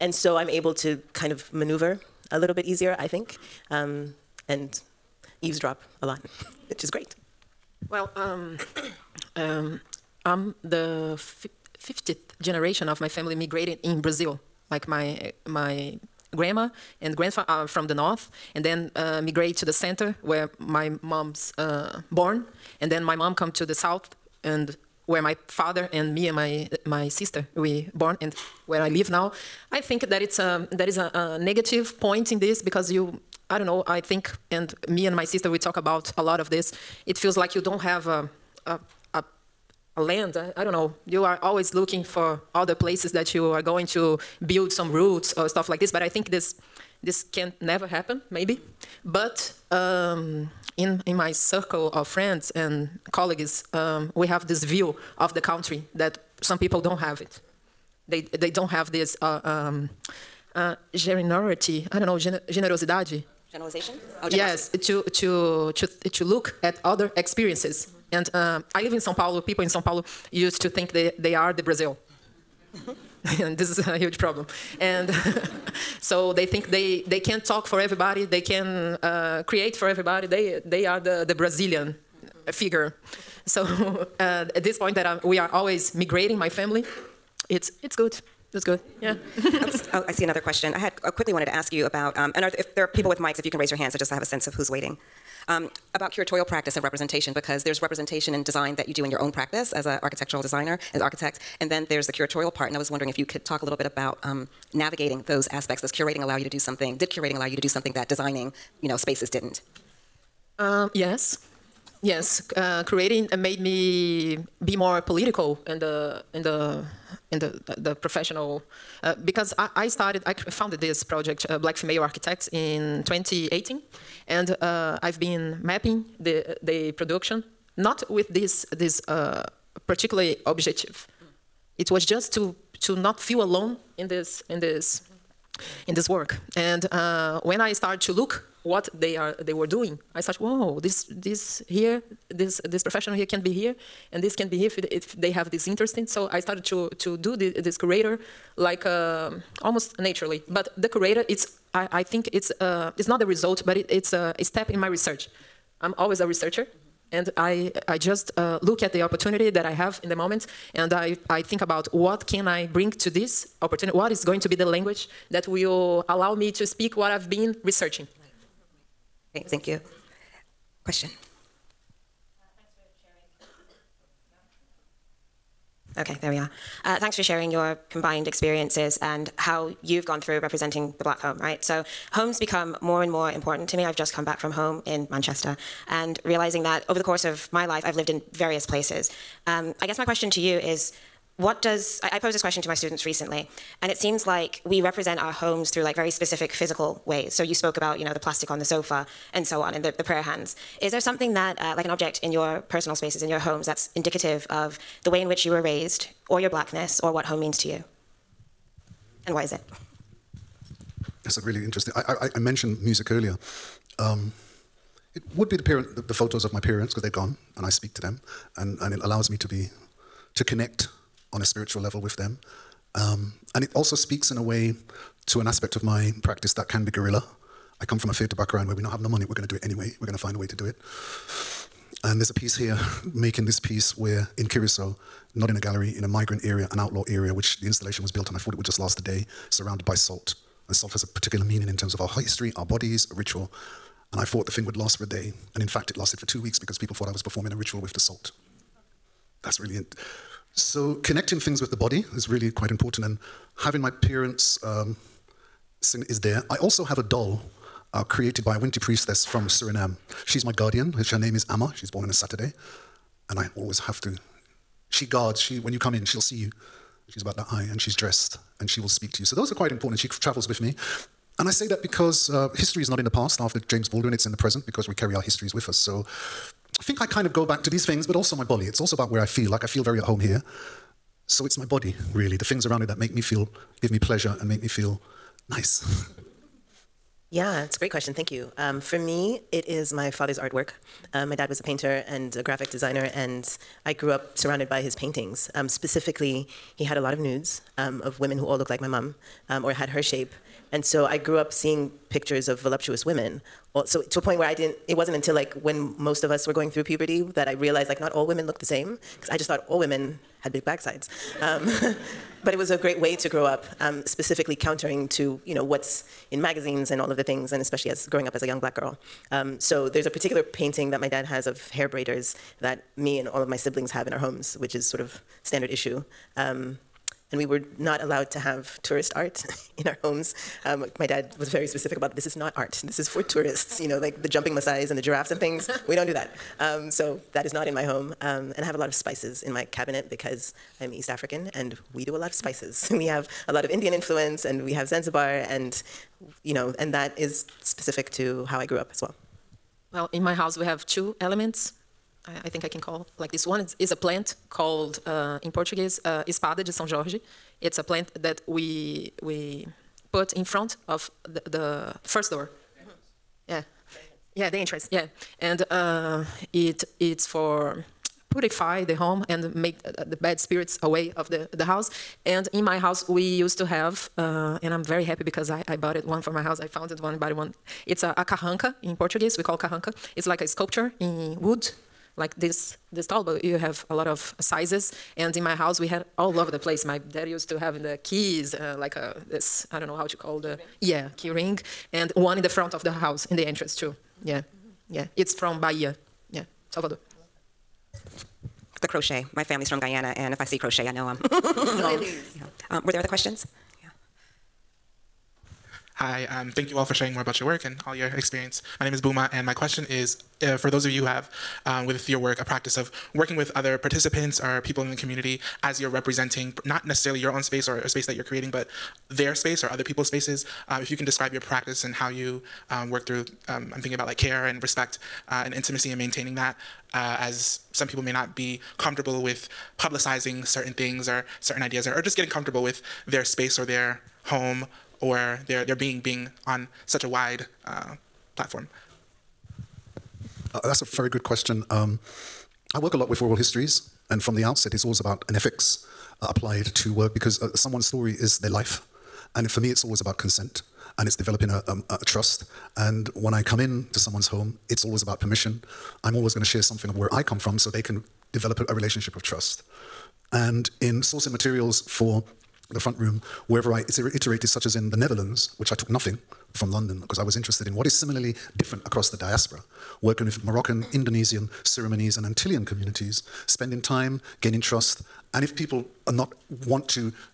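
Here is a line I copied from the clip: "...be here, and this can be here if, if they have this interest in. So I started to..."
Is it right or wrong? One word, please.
right.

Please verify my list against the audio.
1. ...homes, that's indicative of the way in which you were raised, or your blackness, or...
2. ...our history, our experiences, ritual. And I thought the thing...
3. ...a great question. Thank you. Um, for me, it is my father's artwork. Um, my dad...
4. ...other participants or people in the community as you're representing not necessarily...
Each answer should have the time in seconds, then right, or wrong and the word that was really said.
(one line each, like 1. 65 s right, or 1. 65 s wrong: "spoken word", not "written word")
1. 203 s right
2. 242 s wrong: "bodies", not "experiences"
3. 287 s right
4. 413 s right.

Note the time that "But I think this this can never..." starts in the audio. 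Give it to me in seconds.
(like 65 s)
45 s.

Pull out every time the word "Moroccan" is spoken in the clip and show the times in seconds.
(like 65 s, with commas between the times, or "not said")
470 s.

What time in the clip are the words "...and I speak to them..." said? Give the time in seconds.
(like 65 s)
217 s.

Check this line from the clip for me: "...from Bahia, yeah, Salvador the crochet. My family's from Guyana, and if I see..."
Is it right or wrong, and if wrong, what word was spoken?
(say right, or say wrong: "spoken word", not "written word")
right.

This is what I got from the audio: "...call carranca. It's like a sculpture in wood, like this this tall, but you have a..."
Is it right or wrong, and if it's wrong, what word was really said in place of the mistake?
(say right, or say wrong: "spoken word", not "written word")
right.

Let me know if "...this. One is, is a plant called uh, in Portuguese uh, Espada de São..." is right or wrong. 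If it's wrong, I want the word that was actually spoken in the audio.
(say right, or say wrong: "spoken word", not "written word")
right.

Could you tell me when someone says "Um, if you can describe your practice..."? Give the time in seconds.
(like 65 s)
420 s.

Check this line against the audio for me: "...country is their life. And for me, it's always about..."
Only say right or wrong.
wrong.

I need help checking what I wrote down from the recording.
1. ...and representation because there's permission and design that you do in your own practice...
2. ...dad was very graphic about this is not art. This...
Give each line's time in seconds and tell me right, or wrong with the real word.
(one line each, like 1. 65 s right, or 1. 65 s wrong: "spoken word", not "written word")
1. 96 s wrong: "representation", not "permission"
2. 331 s wrong: "specific", not "graphic".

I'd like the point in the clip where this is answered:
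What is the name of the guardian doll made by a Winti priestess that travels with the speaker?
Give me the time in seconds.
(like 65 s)
261 s.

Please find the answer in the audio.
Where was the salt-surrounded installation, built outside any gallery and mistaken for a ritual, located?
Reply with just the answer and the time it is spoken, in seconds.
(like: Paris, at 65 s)
Curacao, at 234 s.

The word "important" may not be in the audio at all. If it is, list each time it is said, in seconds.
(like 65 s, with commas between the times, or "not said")
183 s, 252 s, 269 s.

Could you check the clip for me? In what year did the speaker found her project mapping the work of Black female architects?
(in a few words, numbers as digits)
2018.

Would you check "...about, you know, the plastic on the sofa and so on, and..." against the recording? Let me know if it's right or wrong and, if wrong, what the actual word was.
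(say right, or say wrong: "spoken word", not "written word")
right.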